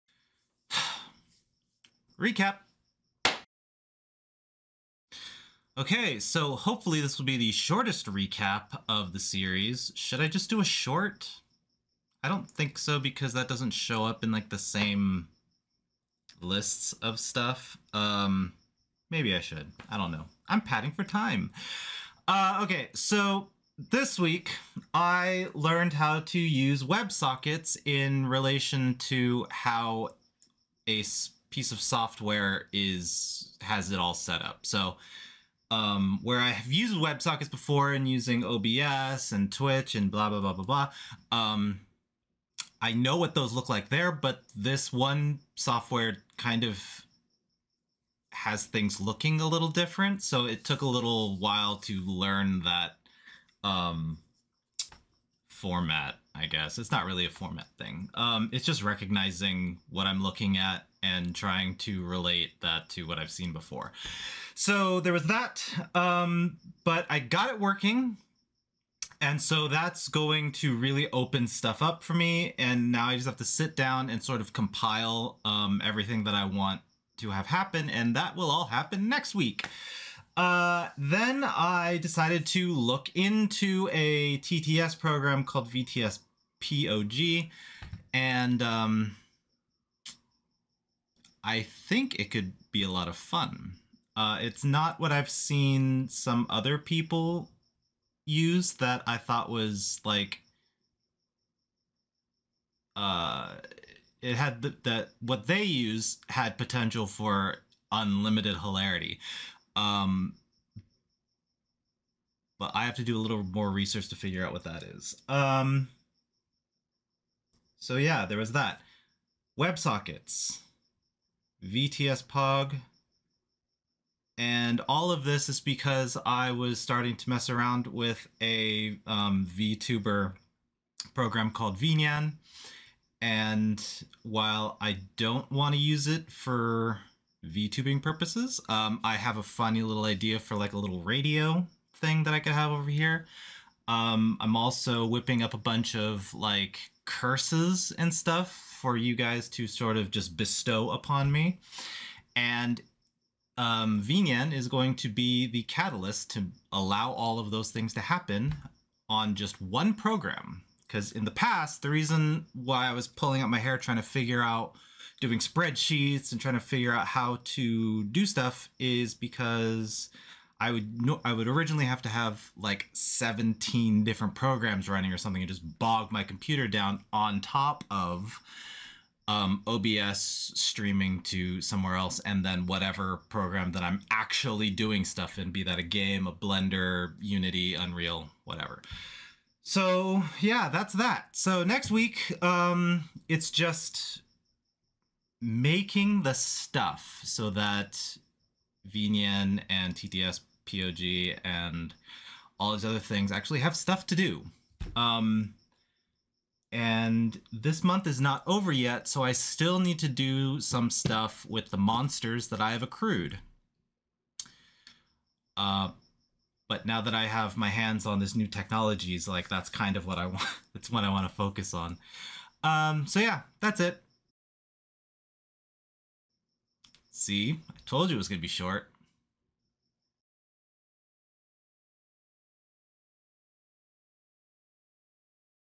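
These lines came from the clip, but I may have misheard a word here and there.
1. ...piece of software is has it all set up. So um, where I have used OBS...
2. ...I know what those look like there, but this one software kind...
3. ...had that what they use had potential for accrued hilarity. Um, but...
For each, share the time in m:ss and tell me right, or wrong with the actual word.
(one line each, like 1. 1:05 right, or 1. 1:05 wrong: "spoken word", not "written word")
1. 0:31 wrong: "WebSockets", not "OBS"
2. 0:42 right
3. 1:44 wrong: "unlimited", not "accrued".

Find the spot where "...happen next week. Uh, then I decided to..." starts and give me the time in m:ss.
1:18.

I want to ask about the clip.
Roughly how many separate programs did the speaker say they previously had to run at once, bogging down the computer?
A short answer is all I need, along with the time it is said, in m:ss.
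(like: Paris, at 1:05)
17, at 2:52.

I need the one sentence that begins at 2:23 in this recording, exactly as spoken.
Um, I'm also whipping up a bunch of like curses and stuff for you guys to sort of just bestow upon me.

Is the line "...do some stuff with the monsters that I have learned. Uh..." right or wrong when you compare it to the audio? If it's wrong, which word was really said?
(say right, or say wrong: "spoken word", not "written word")
wrong: "accrued", not "learned".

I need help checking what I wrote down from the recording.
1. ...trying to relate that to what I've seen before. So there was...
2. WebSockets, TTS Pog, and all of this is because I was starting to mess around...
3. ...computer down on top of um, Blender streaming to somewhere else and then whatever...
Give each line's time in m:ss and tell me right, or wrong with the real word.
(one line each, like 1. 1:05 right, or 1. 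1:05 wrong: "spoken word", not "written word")
1. 1:01 right
2. 1:59 wrong: "VTS", not "TTS"
3. 2:56 wrong: "OBS", not "Blender".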